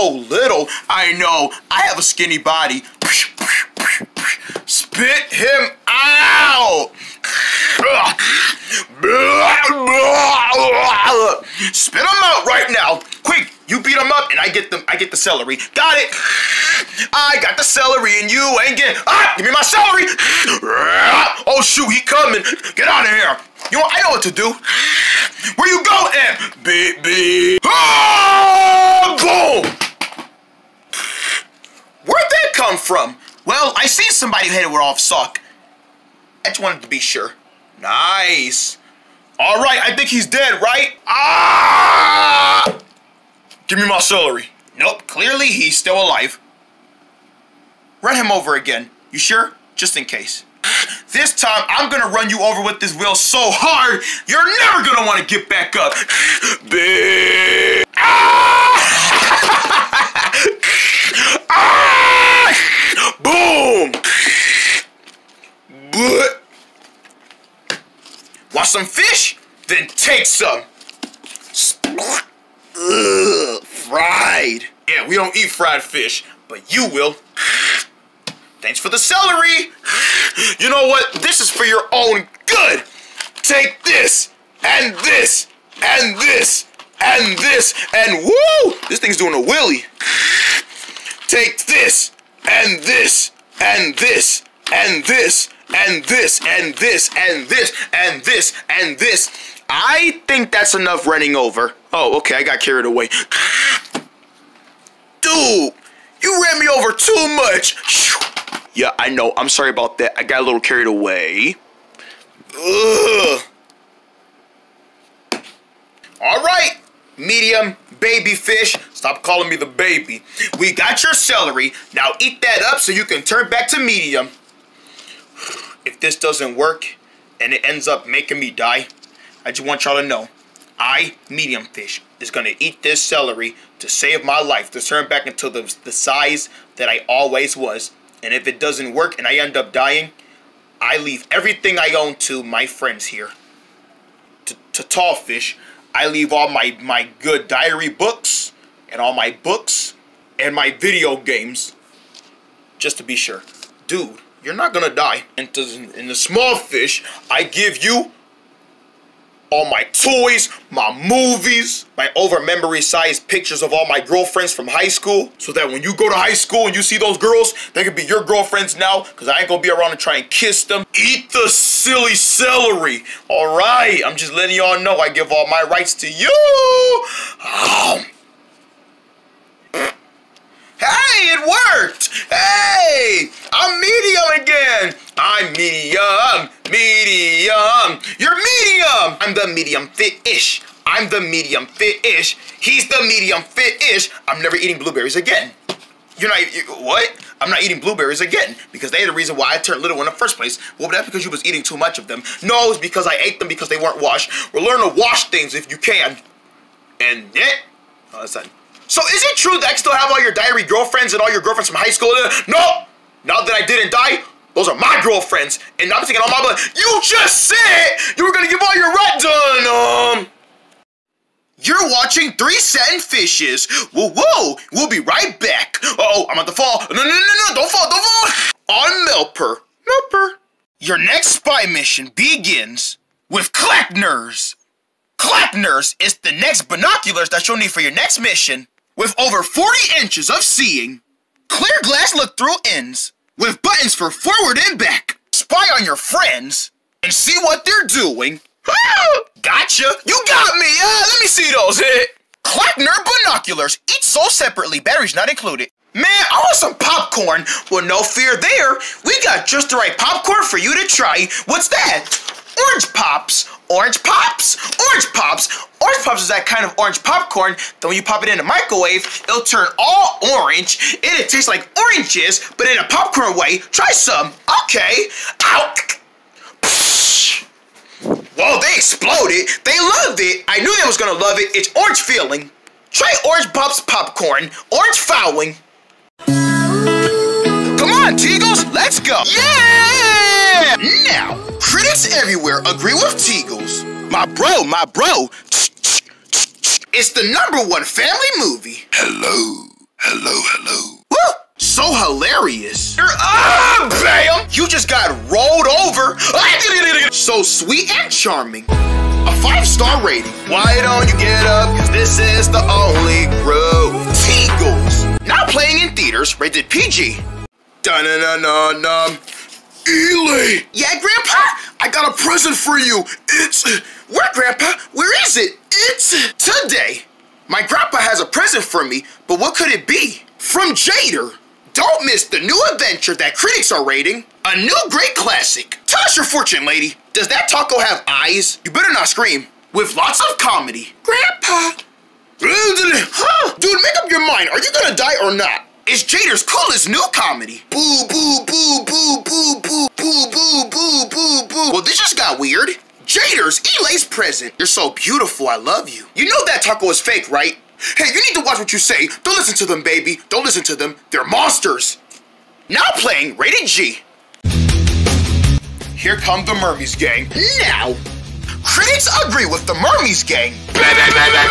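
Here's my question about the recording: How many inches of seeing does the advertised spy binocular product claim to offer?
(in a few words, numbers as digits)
40.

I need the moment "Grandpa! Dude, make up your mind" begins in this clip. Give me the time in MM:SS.
05:41.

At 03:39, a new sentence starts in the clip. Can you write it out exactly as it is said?
Um, you're watching Three Satin Fishes.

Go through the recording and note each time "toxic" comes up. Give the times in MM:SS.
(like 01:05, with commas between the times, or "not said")
not said.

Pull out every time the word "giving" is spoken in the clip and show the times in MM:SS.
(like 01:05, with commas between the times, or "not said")
not said.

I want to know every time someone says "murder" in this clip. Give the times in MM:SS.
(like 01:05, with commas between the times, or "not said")
not said.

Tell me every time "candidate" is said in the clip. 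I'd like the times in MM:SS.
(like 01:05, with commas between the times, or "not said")
not said.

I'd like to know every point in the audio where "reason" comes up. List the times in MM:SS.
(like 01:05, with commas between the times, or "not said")
03:19.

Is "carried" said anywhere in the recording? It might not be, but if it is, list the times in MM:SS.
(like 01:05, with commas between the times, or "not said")
01:42, 01:50.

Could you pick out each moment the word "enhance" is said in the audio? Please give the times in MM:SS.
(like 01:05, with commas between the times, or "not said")
not said.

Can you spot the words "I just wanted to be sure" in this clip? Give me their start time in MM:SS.
00:36.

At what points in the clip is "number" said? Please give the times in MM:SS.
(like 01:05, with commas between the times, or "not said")
04:57.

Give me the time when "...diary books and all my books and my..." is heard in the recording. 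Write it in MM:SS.
02:27.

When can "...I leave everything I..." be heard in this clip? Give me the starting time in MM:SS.
02:20.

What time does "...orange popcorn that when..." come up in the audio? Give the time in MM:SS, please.
04:26.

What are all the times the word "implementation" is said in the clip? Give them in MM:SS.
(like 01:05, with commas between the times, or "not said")
not said.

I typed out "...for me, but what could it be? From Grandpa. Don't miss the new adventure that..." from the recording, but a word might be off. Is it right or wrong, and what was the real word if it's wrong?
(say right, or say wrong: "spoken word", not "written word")
wrong: "Jader", not "Grandpa".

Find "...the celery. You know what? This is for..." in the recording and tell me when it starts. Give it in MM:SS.
01:18.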